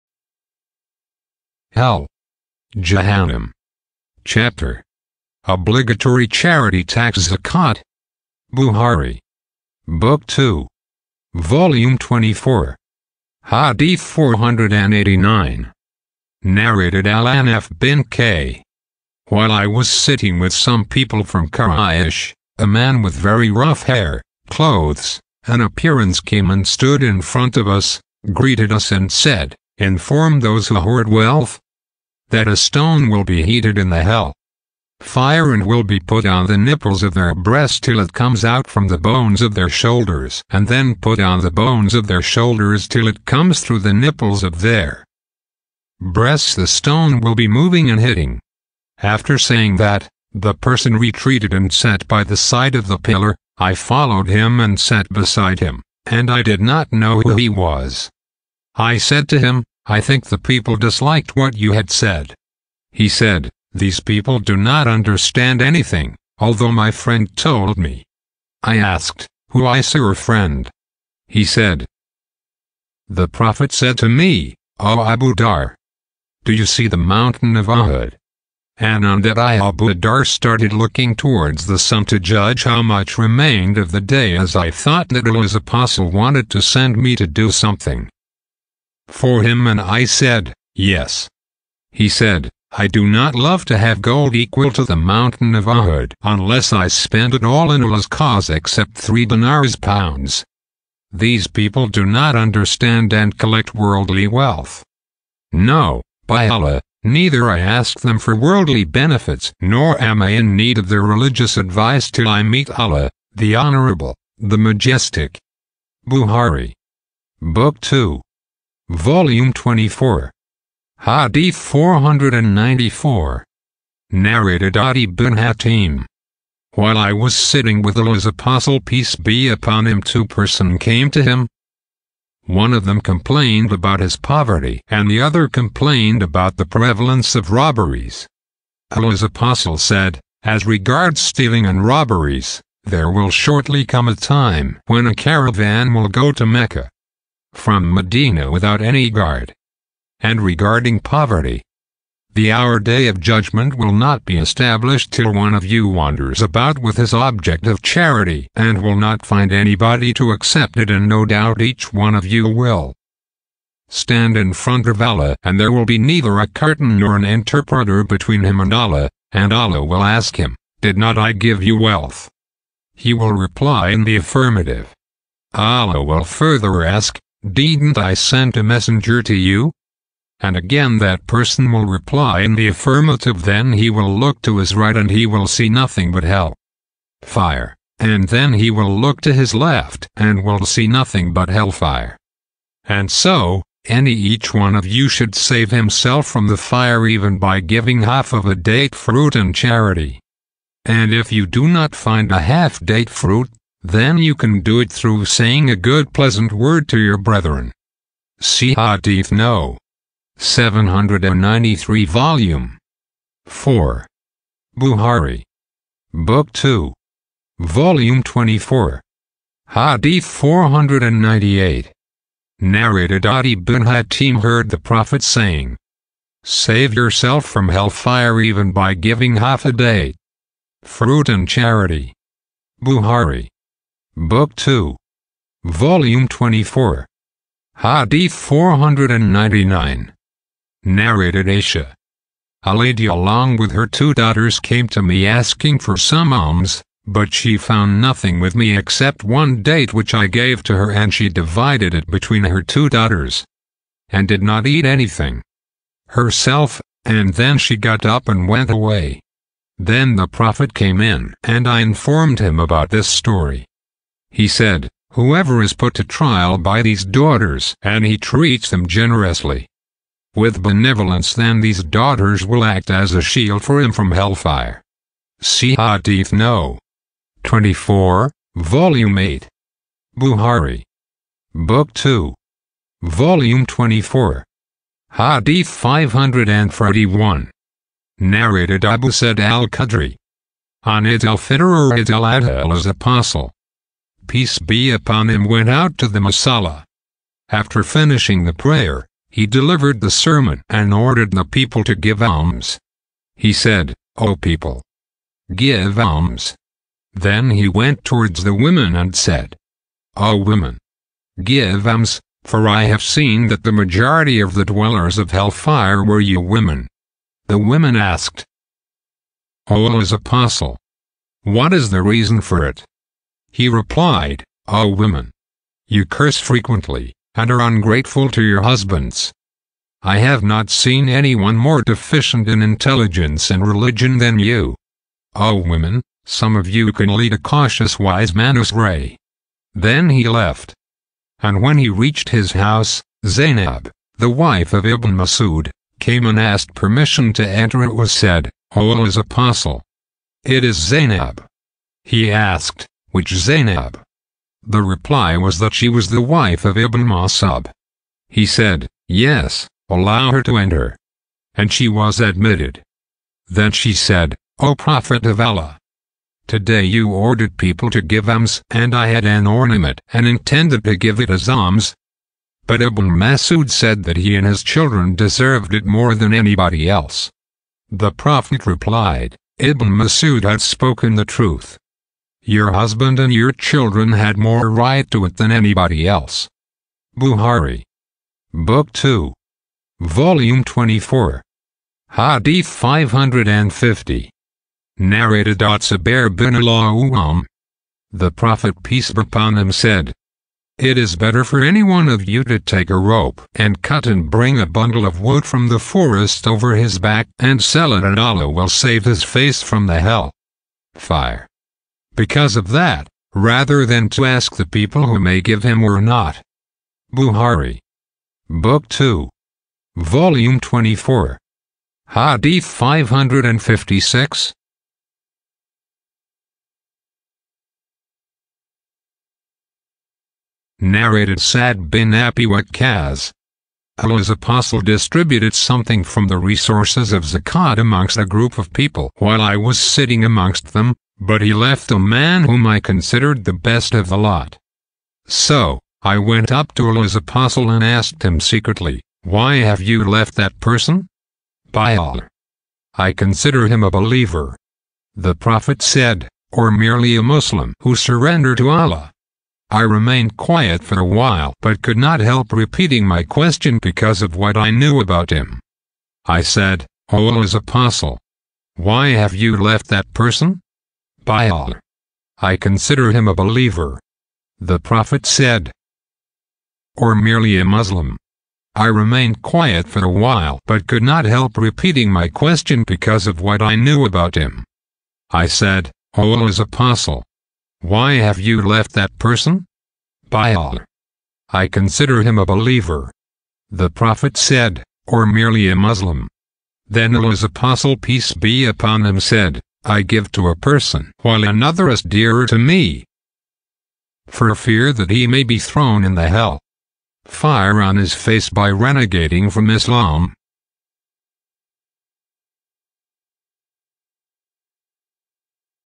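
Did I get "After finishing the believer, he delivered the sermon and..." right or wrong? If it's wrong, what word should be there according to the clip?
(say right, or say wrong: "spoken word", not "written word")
wrong: "prayer", not "believer".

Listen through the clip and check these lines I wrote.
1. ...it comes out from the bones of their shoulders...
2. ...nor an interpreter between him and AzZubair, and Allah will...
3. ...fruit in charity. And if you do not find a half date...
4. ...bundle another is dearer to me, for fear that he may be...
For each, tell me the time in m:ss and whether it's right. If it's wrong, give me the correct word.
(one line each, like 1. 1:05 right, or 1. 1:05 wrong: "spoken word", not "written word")
1. 0:37 right
2. 2:46 wrong: "Allah", not "AzZubair"
3. 3:18 right
4. 8:21 wrong: "while", not "bundle".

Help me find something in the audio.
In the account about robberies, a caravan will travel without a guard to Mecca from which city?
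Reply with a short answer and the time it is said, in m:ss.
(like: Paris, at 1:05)
Medina, at 2:27.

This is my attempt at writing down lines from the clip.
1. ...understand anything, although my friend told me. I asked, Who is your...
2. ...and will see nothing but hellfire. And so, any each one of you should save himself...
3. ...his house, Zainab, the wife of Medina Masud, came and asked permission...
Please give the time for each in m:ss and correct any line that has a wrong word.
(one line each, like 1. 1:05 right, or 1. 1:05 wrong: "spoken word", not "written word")
1. 1:04 right
2. 3:10 right
3. 5:42 wrong: "Ibn", not "Medina".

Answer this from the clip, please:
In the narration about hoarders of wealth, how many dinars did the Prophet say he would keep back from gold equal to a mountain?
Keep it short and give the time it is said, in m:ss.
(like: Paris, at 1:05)
3, at 1:38.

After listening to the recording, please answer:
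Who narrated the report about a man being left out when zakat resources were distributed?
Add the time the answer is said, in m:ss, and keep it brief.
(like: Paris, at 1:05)
Sad bin Abi Waqqas, at 7:11.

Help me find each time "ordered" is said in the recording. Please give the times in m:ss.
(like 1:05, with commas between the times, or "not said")
5:00, 6:07.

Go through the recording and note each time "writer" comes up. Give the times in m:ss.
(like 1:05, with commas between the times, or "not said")
not said.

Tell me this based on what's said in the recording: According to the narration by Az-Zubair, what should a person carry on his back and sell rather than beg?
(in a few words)
Bundle of wood.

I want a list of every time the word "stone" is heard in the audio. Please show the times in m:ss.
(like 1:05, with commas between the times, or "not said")
0:32, 0:46.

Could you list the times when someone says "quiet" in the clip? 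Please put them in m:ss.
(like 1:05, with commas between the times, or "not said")
7:40, 7:59.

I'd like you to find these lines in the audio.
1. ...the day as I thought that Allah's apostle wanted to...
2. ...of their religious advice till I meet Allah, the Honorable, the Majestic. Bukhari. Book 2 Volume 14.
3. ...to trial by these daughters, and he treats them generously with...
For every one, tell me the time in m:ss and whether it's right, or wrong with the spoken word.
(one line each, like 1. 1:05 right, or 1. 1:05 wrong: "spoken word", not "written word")
1. 1:23 right
2. 1:50 wrong: "24", not "14"
3. 4:25 right.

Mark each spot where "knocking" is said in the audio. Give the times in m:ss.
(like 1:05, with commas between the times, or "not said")
not said.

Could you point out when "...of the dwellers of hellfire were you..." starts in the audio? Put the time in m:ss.
5:14.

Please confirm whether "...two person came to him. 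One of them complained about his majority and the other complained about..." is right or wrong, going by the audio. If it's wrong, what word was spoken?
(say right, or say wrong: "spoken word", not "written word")
wrong: "poverty", not "majority".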